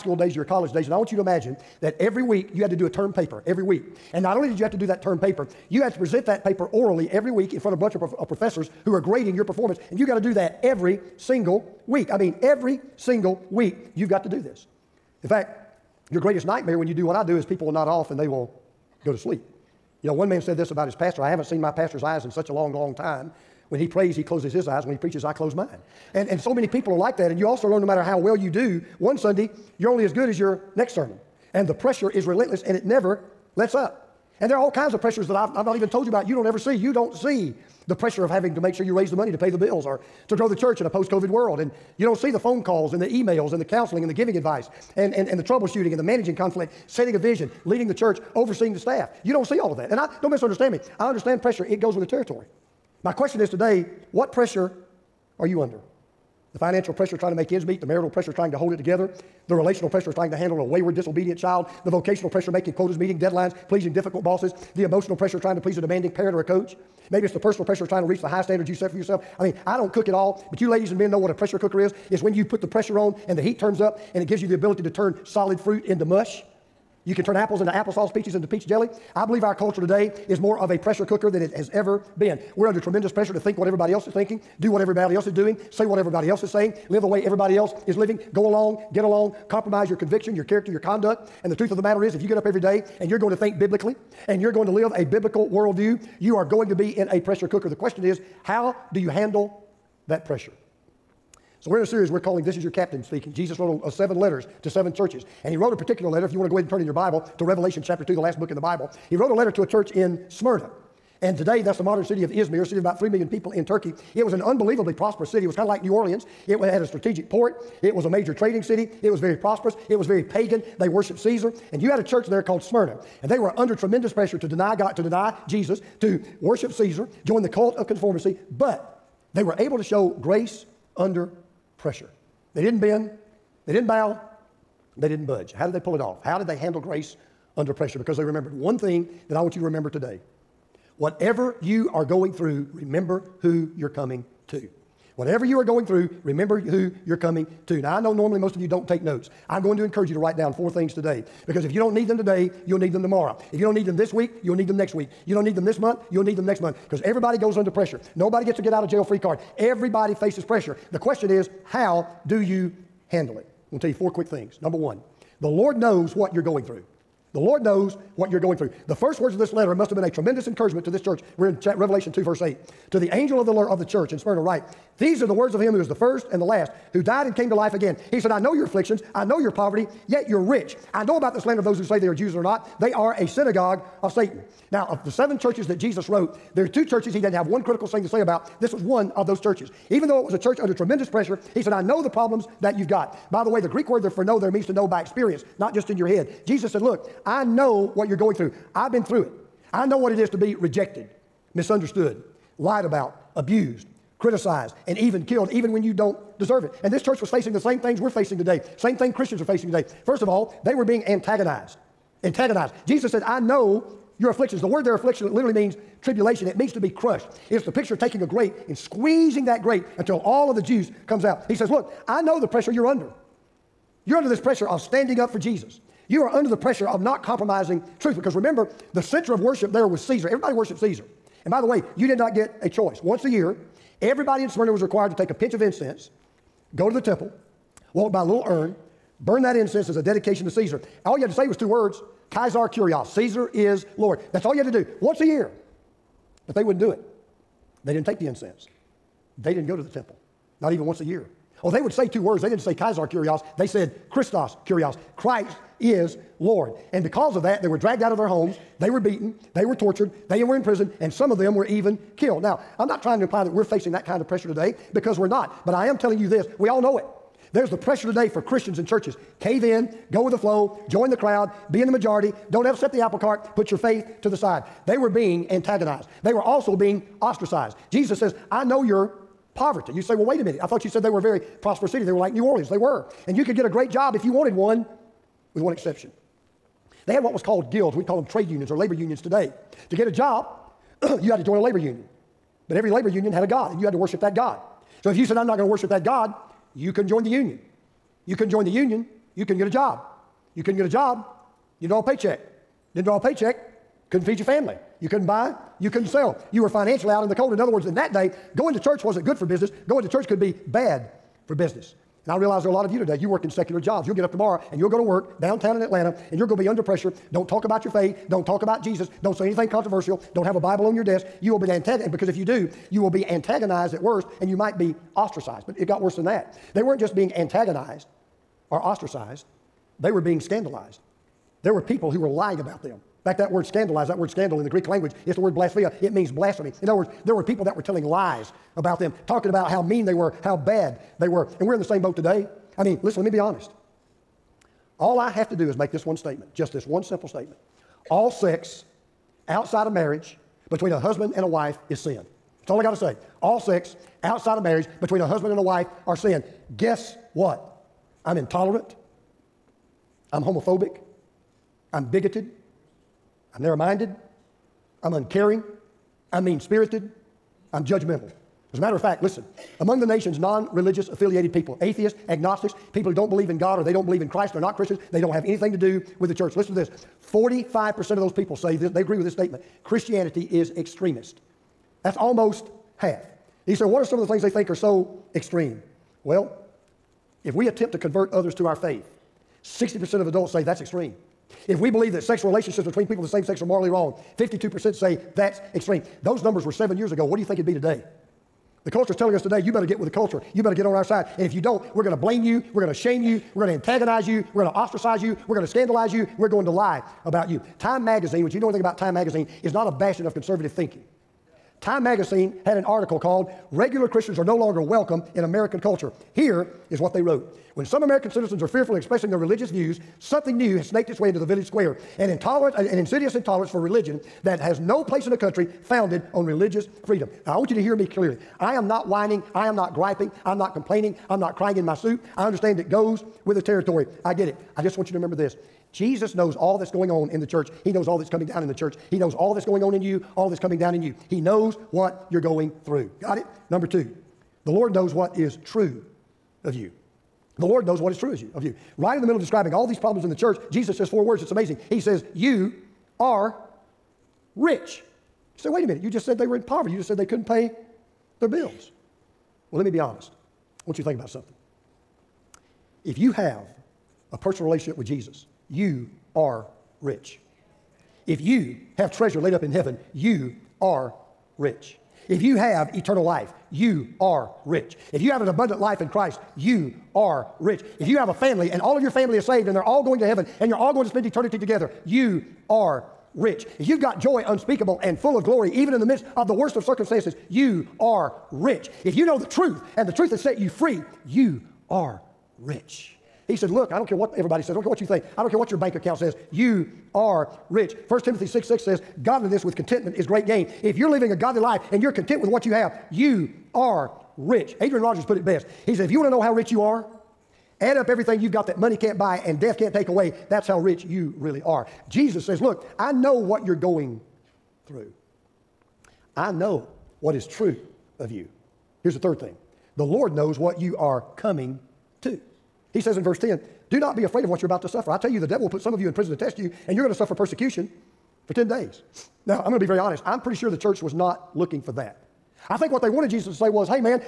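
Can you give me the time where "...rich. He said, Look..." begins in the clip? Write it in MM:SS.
08:12.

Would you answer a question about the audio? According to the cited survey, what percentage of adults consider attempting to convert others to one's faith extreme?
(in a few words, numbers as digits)
60%.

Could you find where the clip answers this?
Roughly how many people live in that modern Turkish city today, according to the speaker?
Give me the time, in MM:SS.
01:52.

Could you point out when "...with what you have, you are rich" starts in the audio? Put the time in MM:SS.
08:22.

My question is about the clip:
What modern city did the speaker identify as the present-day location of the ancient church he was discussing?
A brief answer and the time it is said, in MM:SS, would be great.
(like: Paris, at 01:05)
Izmir, at 01:52.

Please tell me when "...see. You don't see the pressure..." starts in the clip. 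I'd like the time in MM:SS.
00:36.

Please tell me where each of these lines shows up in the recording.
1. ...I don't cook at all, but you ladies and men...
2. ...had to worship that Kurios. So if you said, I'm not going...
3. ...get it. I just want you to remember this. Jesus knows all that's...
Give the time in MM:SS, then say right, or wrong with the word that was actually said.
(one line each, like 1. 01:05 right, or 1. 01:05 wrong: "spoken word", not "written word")
1. 01:09 right
2. 04:53 wrong: "God", not "Kurios"
3. 07:14 right.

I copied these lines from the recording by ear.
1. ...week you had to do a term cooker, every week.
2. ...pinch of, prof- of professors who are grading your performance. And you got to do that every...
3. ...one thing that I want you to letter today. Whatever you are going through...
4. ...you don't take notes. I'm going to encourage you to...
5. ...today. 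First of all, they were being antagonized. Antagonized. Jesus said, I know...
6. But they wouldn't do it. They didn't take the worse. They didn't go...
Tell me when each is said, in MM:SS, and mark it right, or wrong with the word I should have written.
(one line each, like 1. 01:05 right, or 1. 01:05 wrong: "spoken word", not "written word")
1. 00:02 wrong: "paper", not "cooker"
2. 00:07 wrong: "bunch", not "pinch"
3. 02:18 wrong: "remember", not "letter"
4. 02:28 right
5. 03:29 right
6. 04:06 wrong: "incense", not "worse".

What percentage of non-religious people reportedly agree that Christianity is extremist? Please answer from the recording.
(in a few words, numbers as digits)
45%.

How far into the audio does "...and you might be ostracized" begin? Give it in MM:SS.
05:24.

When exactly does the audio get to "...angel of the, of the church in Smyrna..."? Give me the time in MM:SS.
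02:53.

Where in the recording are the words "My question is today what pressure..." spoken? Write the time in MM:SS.
00:53.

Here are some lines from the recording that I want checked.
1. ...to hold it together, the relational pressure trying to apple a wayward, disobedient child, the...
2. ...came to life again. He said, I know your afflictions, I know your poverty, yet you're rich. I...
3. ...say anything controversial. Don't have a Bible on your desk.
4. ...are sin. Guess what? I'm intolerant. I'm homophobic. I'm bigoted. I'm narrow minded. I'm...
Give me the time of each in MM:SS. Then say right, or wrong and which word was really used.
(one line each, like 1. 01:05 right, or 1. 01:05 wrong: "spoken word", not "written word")
1. 00:58 wrong: "handle", not "apple"
2. 02:57 right
3. 05:19 right
4. 05:56 right.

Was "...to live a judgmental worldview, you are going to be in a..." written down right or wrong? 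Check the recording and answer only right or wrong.
wrong.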